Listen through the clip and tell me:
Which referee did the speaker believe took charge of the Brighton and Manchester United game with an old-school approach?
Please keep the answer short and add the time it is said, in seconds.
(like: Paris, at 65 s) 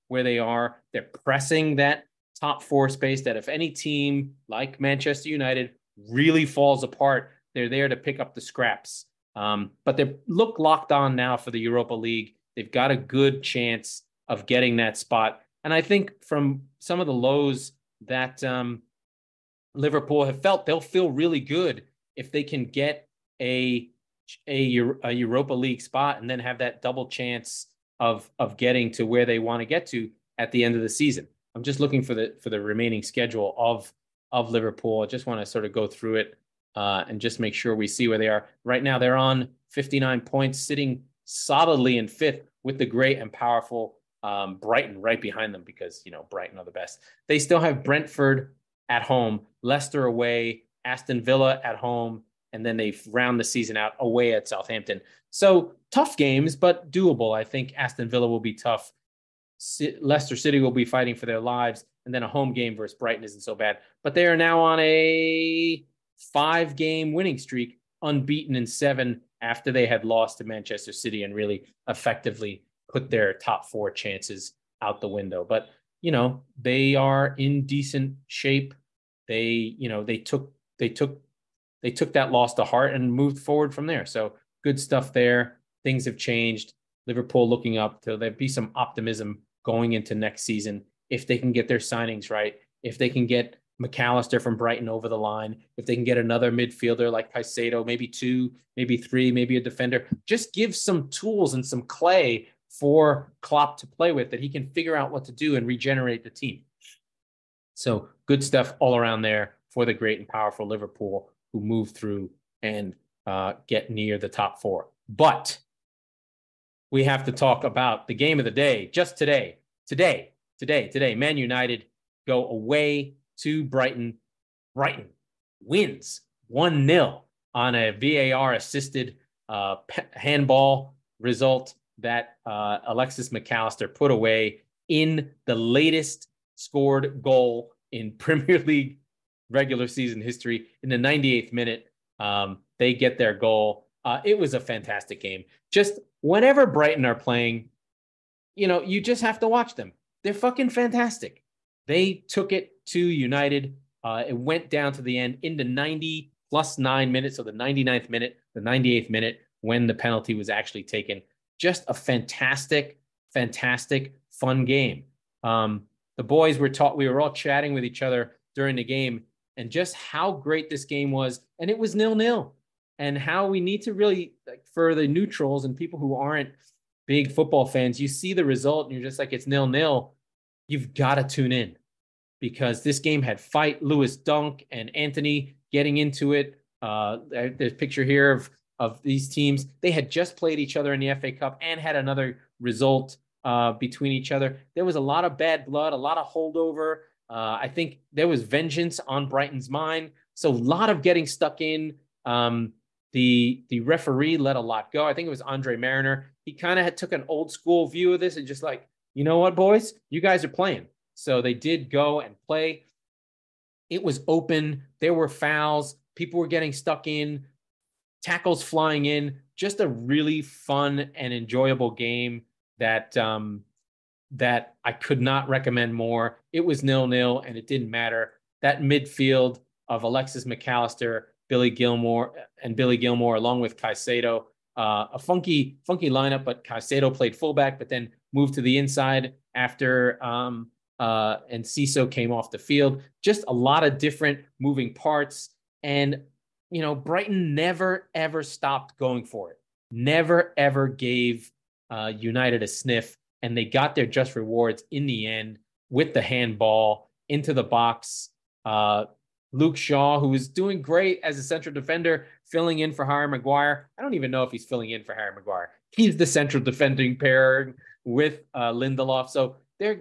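Andre Marriner, at 205 s.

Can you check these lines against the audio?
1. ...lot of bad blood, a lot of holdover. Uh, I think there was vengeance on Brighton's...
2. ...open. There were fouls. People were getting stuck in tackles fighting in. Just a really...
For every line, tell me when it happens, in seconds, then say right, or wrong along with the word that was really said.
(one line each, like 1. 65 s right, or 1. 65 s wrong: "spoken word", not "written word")
1. 195 s right
2. 214 s wrong: "flying", not "fighting".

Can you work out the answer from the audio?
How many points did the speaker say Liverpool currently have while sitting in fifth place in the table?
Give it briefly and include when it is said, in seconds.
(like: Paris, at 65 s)
59, at 39 s.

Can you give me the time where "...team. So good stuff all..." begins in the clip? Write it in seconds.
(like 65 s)
106 s.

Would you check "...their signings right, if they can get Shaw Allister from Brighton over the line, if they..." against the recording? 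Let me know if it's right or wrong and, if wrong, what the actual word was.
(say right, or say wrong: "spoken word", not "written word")
wrong: "Mac", not "Shaw".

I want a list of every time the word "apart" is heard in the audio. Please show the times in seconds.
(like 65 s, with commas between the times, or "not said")
6 s.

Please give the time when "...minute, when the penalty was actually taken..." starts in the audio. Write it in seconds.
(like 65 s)
159 s.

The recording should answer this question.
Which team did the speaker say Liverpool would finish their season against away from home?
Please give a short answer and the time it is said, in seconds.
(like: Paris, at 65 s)
Southampton, at 54 s.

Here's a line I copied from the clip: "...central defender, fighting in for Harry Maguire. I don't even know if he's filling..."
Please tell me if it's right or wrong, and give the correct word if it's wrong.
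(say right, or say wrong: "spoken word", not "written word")
wrong: "filling", not "fighting".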